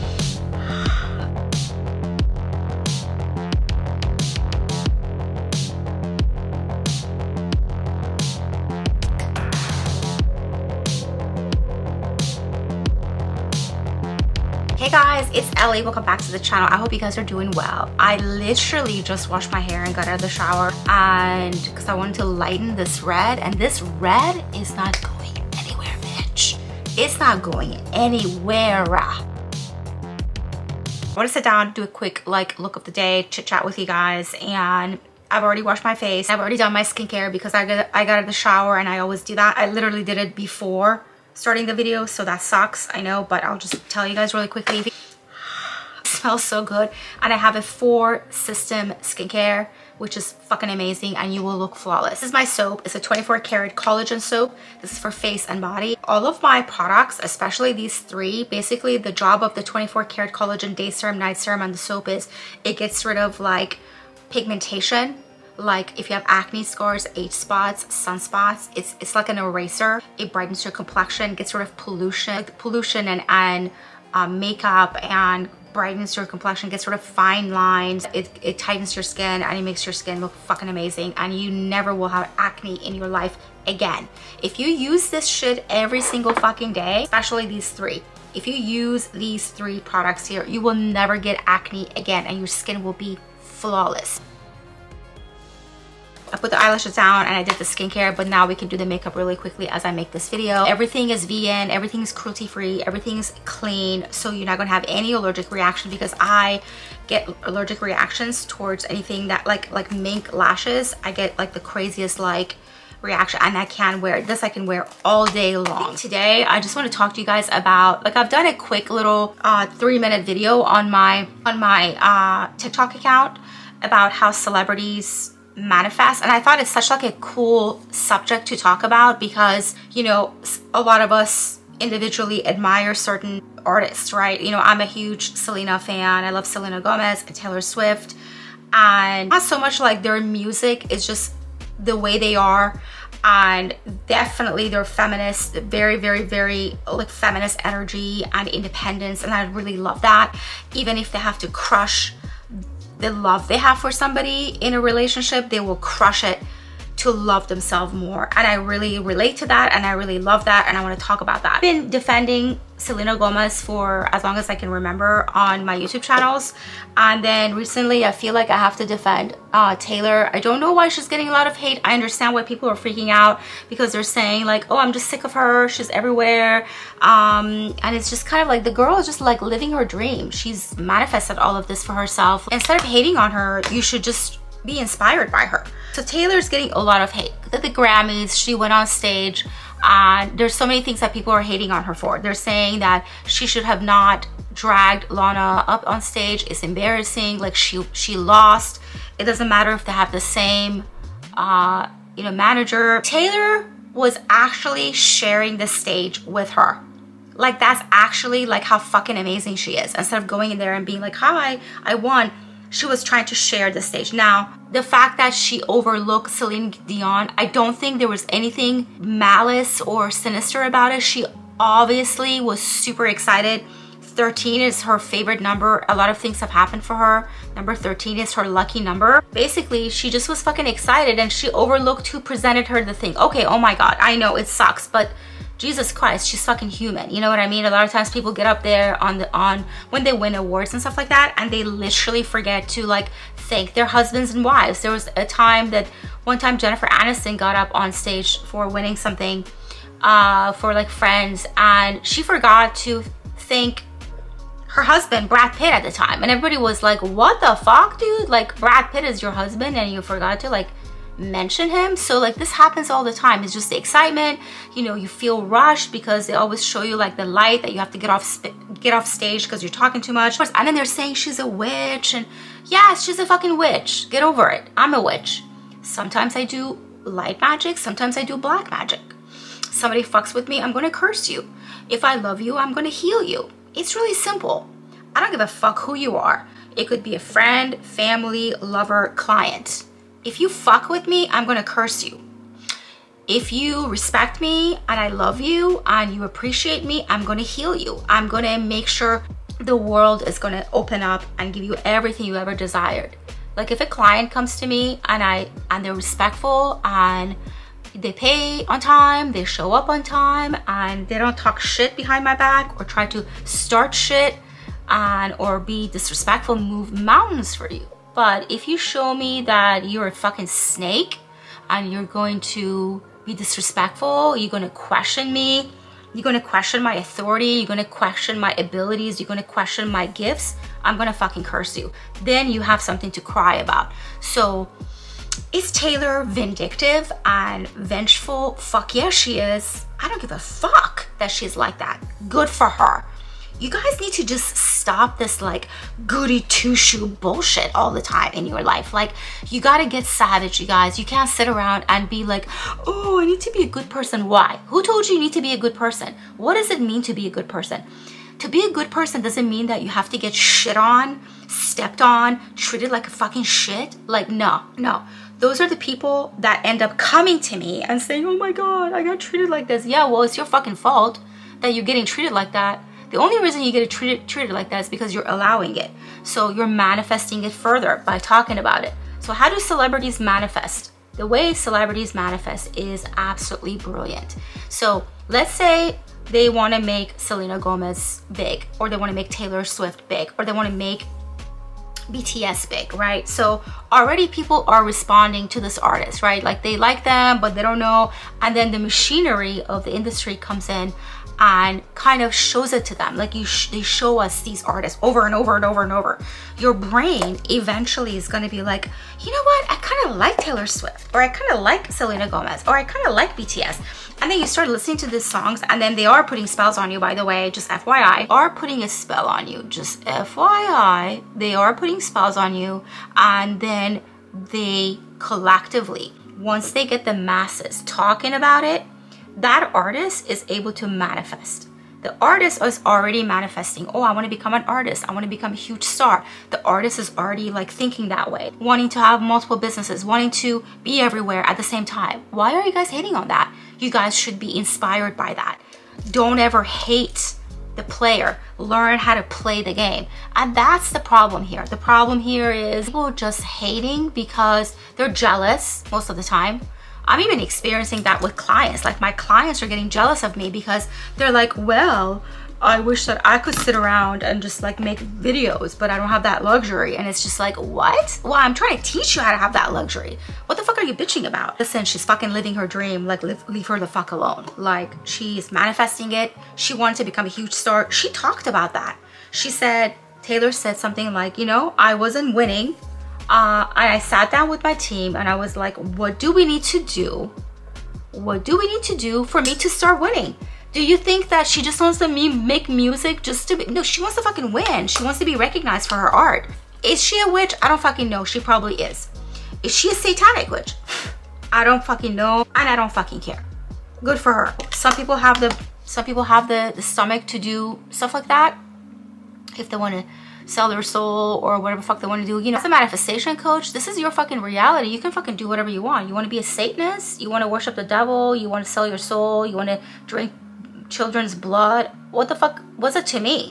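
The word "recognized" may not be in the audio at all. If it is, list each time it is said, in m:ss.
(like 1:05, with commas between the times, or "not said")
8:15.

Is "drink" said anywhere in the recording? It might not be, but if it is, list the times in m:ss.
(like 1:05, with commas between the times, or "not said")
8:40.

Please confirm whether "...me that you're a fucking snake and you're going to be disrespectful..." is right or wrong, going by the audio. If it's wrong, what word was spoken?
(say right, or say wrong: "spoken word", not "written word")
right.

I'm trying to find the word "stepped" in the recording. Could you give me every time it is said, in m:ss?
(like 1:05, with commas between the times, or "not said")
6:01.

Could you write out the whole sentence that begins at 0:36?
I've already done my skincare because I got, I got out of the shower and I always do that.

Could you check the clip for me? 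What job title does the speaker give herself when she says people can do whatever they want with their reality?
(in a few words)
manifestation coach.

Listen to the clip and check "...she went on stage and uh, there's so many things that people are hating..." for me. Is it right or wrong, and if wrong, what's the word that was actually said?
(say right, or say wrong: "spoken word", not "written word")
right.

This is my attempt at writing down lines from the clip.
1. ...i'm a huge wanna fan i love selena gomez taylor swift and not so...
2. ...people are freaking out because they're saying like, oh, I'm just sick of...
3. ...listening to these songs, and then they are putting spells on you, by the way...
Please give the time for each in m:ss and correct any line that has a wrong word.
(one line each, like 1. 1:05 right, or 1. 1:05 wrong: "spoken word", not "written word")
1. 2:14 wrong: "selena", not "wanna"
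2. 2:52 right
3. 6:54 right.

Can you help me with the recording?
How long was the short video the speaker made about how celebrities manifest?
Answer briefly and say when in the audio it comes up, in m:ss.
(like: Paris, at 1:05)
3 minutes, at 1:59.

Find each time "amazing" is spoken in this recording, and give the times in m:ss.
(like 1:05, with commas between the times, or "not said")
0:50, 1:20, 3:29.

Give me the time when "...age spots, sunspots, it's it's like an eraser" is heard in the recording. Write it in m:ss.
1:07.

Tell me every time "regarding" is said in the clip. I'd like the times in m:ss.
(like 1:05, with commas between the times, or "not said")
not said.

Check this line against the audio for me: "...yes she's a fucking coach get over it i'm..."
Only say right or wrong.
wrong.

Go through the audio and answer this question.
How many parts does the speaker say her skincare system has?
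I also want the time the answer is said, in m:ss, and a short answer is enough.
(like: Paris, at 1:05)
4, at 0:47.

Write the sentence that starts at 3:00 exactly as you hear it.
She's manifested all of this for herself.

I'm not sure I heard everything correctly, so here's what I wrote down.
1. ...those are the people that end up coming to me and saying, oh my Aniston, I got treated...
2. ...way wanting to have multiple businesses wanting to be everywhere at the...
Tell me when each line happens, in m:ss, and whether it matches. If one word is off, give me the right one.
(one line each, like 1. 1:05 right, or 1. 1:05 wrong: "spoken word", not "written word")
1. 6:05 wrong: "God", not "Aniston"
2. 7:18 right.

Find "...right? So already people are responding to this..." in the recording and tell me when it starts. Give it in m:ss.
6:32.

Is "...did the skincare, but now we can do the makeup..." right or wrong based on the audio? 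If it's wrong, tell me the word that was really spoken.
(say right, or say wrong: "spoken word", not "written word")
right.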